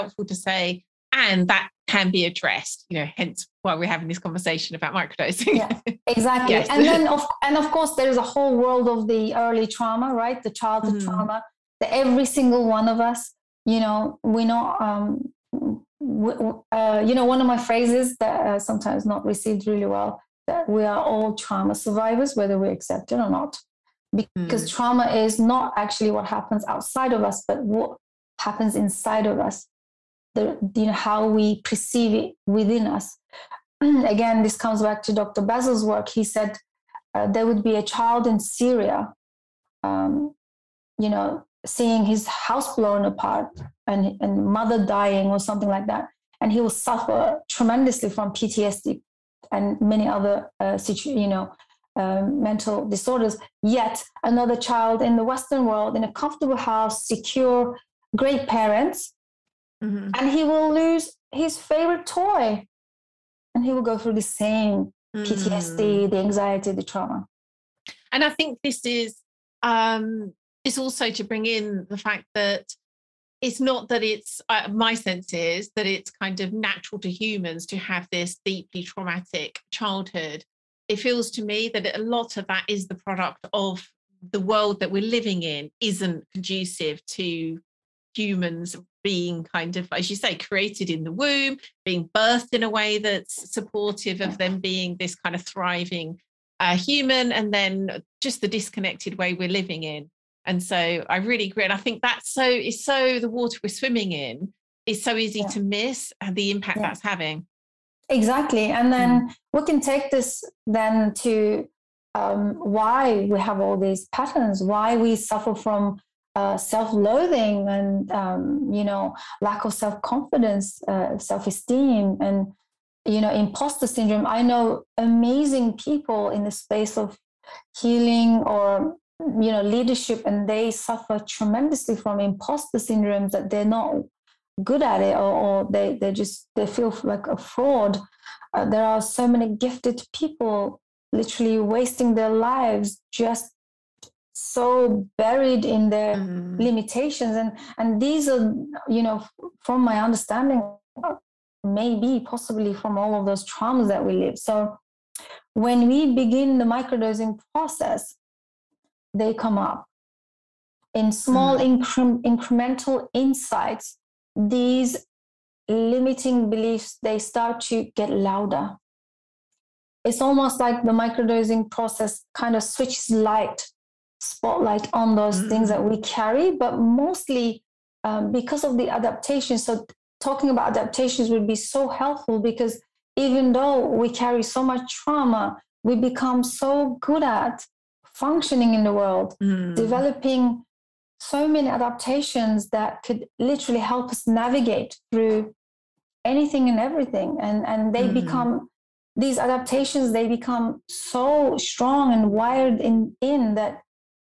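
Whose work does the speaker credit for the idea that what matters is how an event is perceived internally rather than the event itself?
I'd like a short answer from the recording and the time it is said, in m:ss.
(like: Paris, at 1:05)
Dr. Basil, at 0:35.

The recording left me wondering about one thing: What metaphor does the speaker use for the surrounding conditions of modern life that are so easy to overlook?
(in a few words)
The water we're swimming in.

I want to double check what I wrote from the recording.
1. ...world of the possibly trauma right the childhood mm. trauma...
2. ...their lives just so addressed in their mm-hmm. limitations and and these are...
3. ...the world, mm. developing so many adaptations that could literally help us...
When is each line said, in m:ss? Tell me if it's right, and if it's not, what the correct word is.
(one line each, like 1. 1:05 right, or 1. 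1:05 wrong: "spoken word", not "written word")
1. 0:08 wrong: "early", not "possibly"
2. 2:22 wrong: "buried", not "addressed"
3. 3:08 right.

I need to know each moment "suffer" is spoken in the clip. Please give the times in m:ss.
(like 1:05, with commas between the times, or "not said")
0:46, 1:55, 2:10.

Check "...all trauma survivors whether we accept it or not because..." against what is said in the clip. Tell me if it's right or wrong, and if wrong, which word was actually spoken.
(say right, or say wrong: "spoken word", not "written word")
right.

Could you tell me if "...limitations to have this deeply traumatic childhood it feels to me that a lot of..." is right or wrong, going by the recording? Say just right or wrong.
wrong.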